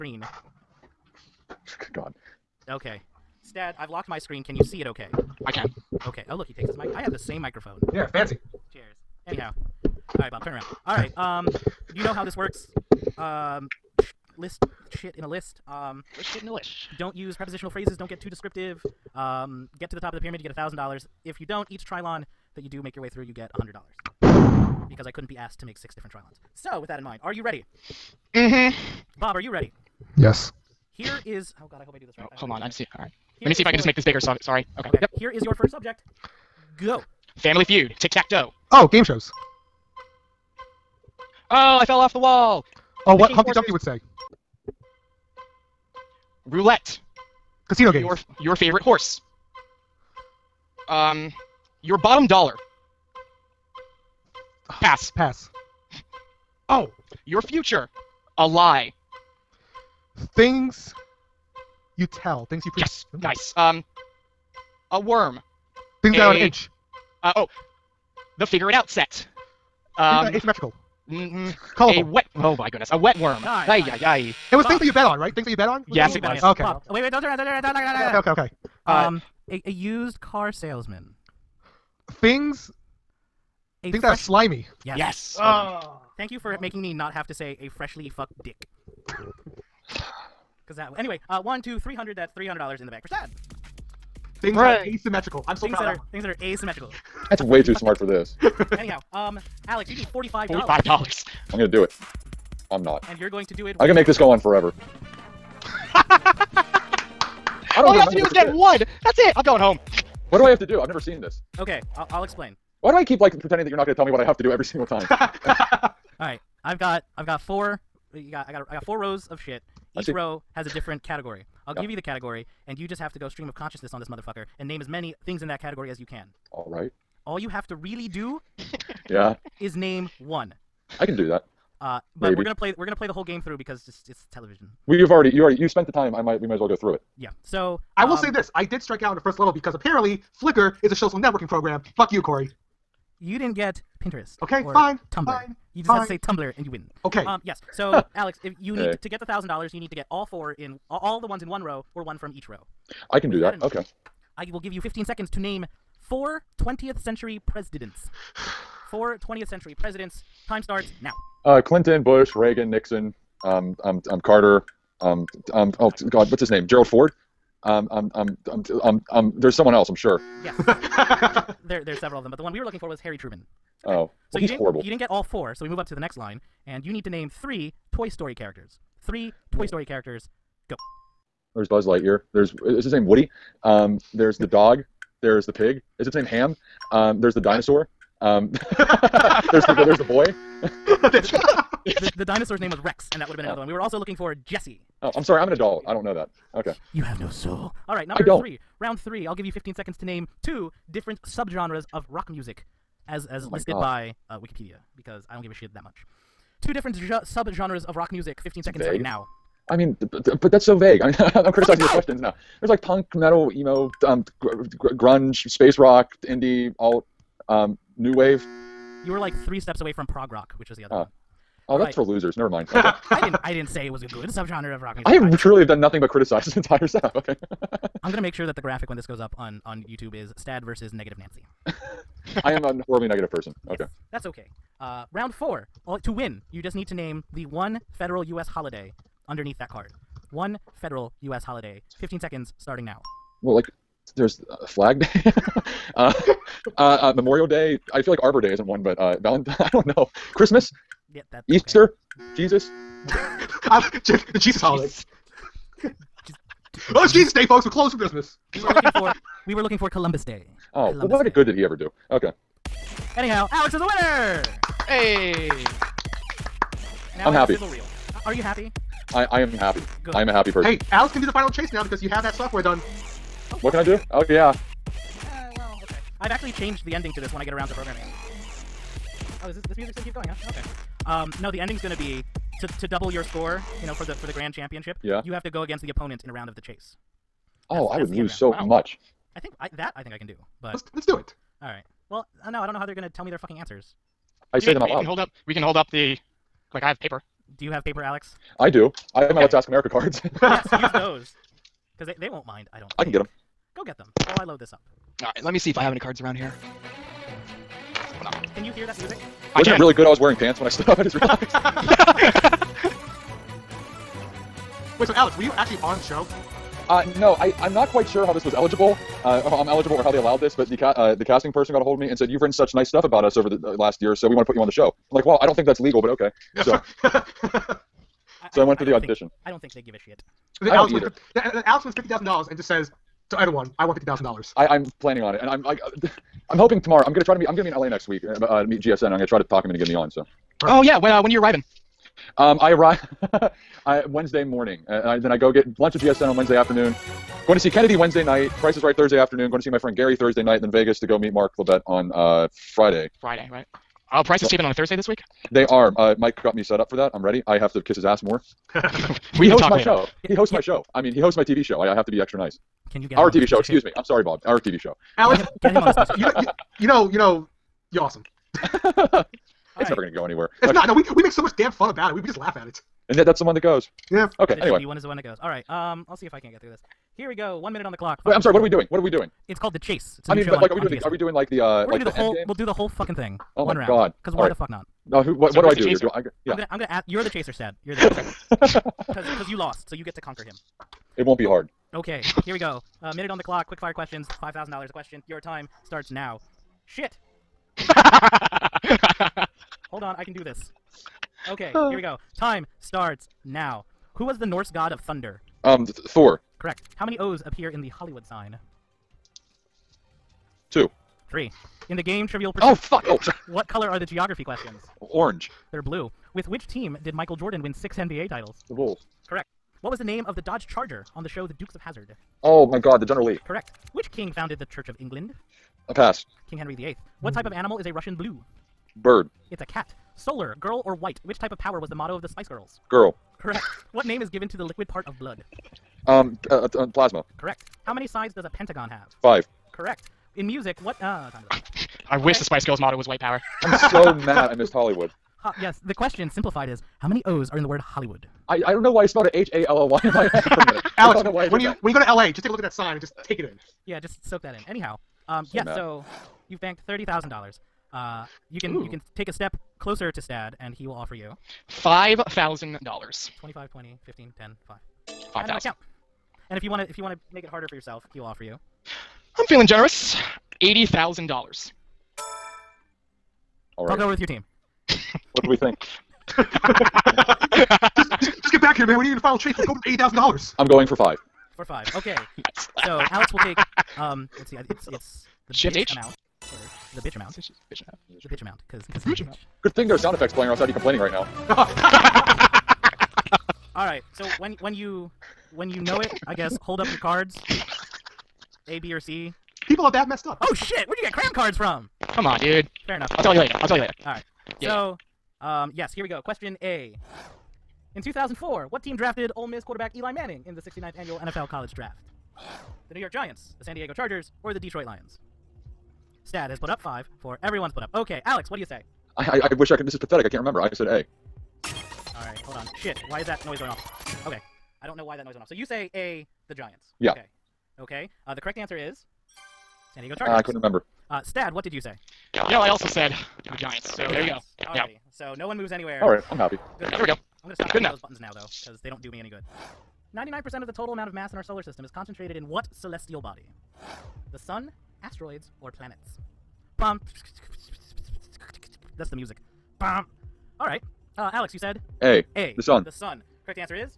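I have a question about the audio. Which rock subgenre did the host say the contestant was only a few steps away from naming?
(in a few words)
Prog rock.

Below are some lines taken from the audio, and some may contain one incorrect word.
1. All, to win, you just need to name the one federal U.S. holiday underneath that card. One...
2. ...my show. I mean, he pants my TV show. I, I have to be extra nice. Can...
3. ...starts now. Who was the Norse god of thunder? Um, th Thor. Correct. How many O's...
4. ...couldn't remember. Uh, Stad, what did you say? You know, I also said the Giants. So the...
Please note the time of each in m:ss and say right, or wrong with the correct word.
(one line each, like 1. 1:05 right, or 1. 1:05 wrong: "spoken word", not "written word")
1. 3:55 right
2. 6:00 wrong: "hosts", not "pants"
3. 6:42 right
4. 8:50 right.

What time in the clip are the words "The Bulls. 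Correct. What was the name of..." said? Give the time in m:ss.
6:58.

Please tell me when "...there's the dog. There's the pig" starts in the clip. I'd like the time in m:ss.
3:04.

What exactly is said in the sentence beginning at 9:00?
99% of the total amount of mass in our solar system is concentrated in what celestial body?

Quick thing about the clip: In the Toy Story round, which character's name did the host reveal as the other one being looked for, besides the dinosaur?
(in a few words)
Jesse.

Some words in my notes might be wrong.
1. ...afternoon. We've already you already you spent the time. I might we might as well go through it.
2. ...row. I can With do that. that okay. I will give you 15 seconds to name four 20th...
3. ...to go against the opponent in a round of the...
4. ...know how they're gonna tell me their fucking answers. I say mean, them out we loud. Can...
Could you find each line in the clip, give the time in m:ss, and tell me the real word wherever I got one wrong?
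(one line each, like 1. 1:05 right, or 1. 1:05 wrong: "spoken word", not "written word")
1. 2:14 wrong: "television", not "afternoon"
2. 2:32 right
3. 4:45 right
4. 4:52 right.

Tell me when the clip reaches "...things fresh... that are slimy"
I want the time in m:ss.
1:23.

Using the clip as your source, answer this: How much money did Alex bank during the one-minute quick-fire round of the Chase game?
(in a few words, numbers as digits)
$30,000.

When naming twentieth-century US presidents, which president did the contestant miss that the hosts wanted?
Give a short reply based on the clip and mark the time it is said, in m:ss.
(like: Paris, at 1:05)
Harry Truman, at 2:52.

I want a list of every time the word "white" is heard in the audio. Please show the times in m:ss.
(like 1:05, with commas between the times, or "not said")
7:10, 7:23.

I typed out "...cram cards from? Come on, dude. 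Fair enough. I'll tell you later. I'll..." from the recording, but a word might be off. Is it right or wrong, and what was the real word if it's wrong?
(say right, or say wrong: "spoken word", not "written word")
right.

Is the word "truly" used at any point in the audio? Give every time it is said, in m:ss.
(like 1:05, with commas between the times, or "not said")
3:45.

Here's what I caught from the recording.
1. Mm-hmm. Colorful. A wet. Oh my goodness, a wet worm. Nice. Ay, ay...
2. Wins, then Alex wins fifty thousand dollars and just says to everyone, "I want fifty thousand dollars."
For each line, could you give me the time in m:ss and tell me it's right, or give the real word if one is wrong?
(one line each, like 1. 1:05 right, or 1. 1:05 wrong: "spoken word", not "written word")
1. 1:11 right
2. 5:31 right.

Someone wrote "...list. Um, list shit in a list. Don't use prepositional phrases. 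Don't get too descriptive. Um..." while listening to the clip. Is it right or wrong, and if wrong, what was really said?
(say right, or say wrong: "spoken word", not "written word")
right.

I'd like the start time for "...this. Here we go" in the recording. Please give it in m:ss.
6:16.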